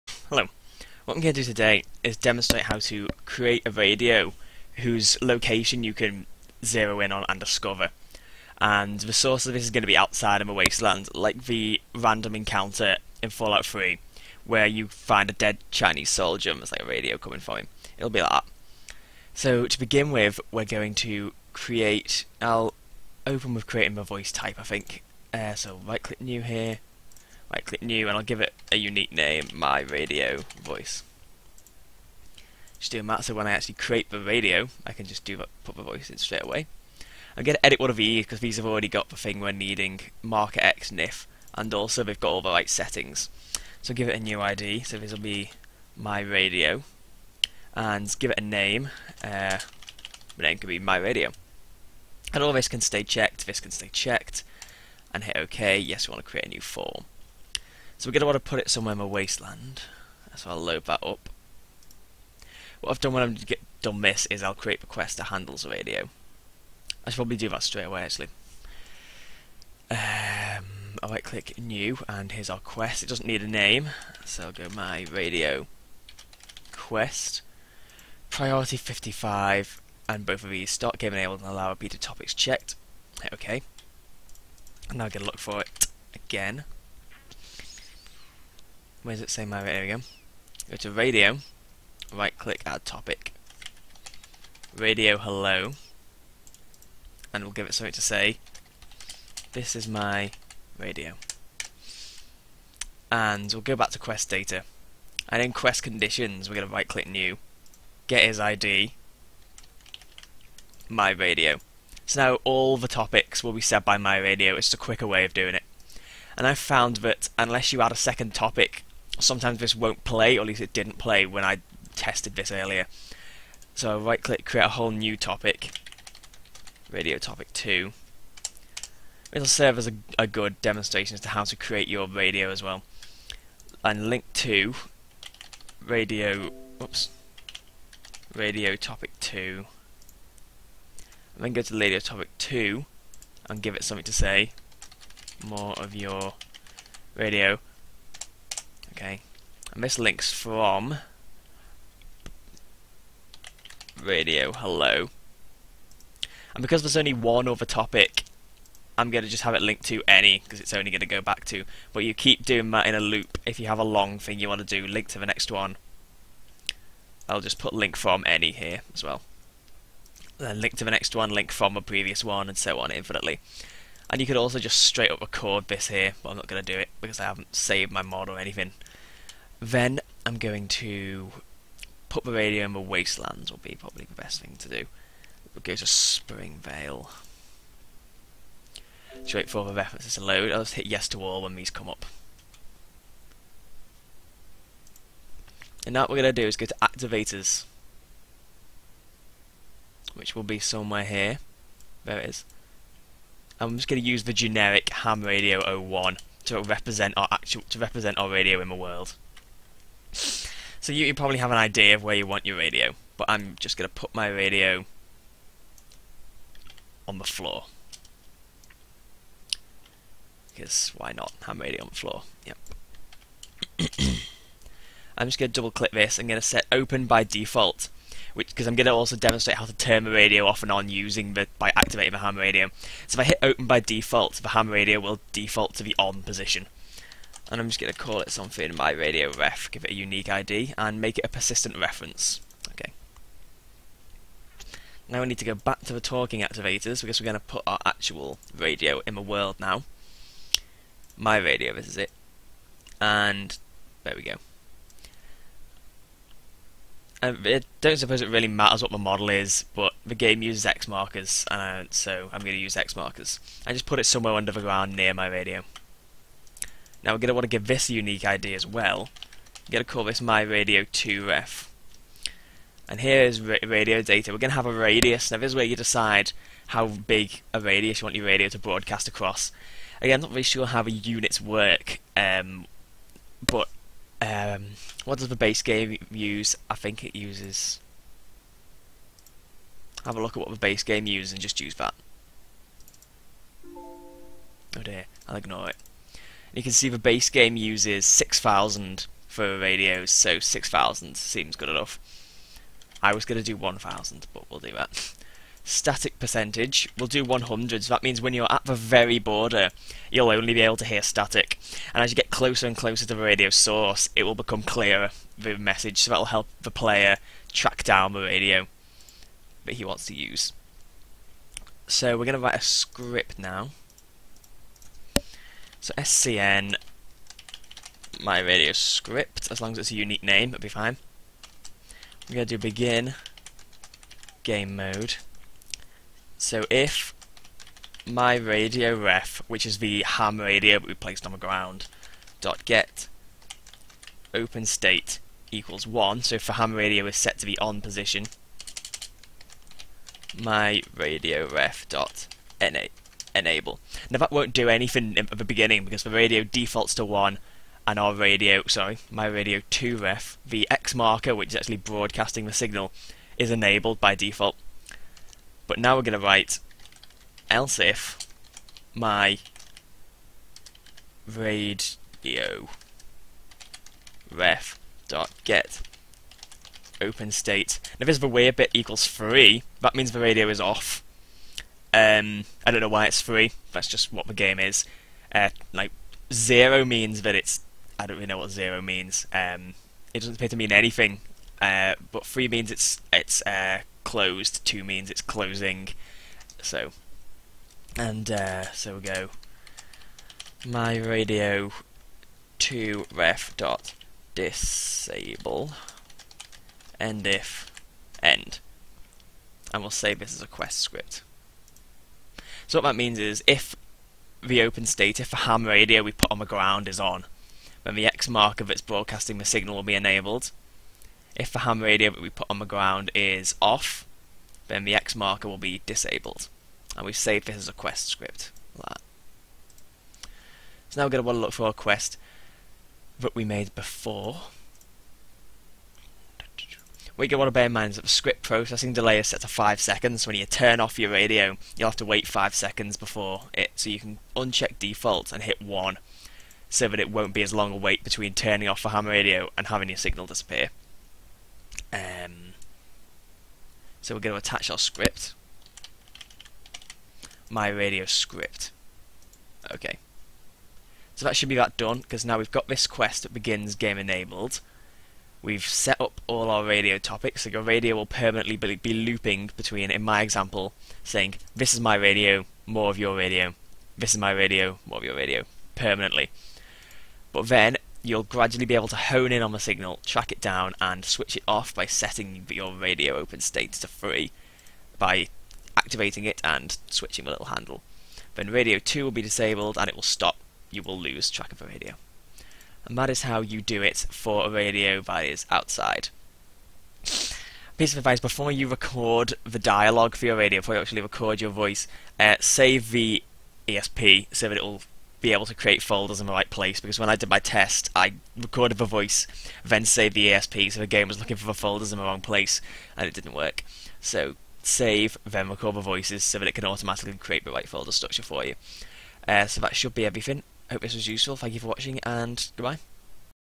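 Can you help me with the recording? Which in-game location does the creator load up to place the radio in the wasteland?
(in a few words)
Springvale.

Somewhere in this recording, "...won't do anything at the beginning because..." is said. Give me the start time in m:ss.
5:54.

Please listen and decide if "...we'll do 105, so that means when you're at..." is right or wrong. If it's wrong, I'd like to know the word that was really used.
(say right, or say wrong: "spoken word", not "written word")
wrong: "100", not "105".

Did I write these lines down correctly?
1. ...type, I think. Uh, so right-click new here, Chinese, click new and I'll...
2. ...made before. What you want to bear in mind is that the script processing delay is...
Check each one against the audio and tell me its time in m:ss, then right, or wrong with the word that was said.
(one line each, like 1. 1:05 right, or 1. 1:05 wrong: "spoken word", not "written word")
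1. 0:24 wrong: "Right", not "Chinese"
2. 7:13 right.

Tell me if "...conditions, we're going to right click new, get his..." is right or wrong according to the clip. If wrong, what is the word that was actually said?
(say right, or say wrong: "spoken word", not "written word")
right.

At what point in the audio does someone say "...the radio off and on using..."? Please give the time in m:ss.
3:50.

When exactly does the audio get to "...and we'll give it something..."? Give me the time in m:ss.
1:37.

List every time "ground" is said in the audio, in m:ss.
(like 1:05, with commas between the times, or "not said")
4:24, 5:41, 6:56, 7:02.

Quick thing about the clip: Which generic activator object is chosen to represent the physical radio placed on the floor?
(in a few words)
ham radio 01.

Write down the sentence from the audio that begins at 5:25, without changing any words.
So SCN, my radio script, as long as it's a unique name, it'll be fine.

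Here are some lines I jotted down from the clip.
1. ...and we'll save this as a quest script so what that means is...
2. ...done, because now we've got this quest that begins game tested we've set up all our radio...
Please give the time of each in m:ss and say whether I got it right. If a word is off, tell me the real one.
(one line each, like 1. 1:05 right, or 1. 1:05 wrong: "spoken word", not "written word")
1. 6:49 right
2. 7:41 wrong: "enabled", not "tested".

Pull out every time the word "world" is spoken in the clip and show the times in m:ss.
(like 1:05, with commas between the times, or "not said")
3:28, 4:09.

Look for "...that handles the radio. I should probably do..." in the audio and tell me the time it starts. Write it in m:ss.
1:05.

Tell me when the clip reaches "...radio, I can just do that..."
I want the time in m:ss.
0:34.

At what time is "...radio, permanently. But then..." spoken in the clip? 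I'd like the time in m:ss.
7:55.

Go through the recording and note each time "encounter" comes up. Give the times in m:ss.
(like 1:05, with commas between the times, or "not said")
0:12.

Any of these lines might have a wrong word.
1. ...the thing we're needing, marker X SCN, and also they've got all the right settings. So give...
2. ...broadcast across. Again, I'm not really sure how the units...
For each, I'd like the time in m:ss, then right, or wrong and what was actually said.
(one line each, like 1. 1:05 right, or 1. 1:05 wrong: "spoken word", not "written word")
1. 0:39 wrong: "NIF", not "SCN"
2. 4:38 right.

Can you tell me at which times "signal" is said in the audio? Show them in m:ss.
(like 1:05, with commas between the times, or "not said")
6:02, 6:59, 7:29, 7:59.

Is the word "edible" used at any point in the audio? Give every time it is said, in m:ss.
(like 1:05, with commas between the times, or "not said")
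not said.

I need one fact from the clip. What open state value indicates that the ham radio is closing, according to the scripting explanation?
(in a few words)
2.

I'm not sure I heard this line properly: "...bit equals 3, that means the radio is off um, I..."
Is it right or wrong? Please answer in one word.
right.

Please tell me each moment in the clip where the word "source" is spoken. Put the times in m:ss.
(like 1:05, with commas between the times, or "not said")
0:09, 5:13.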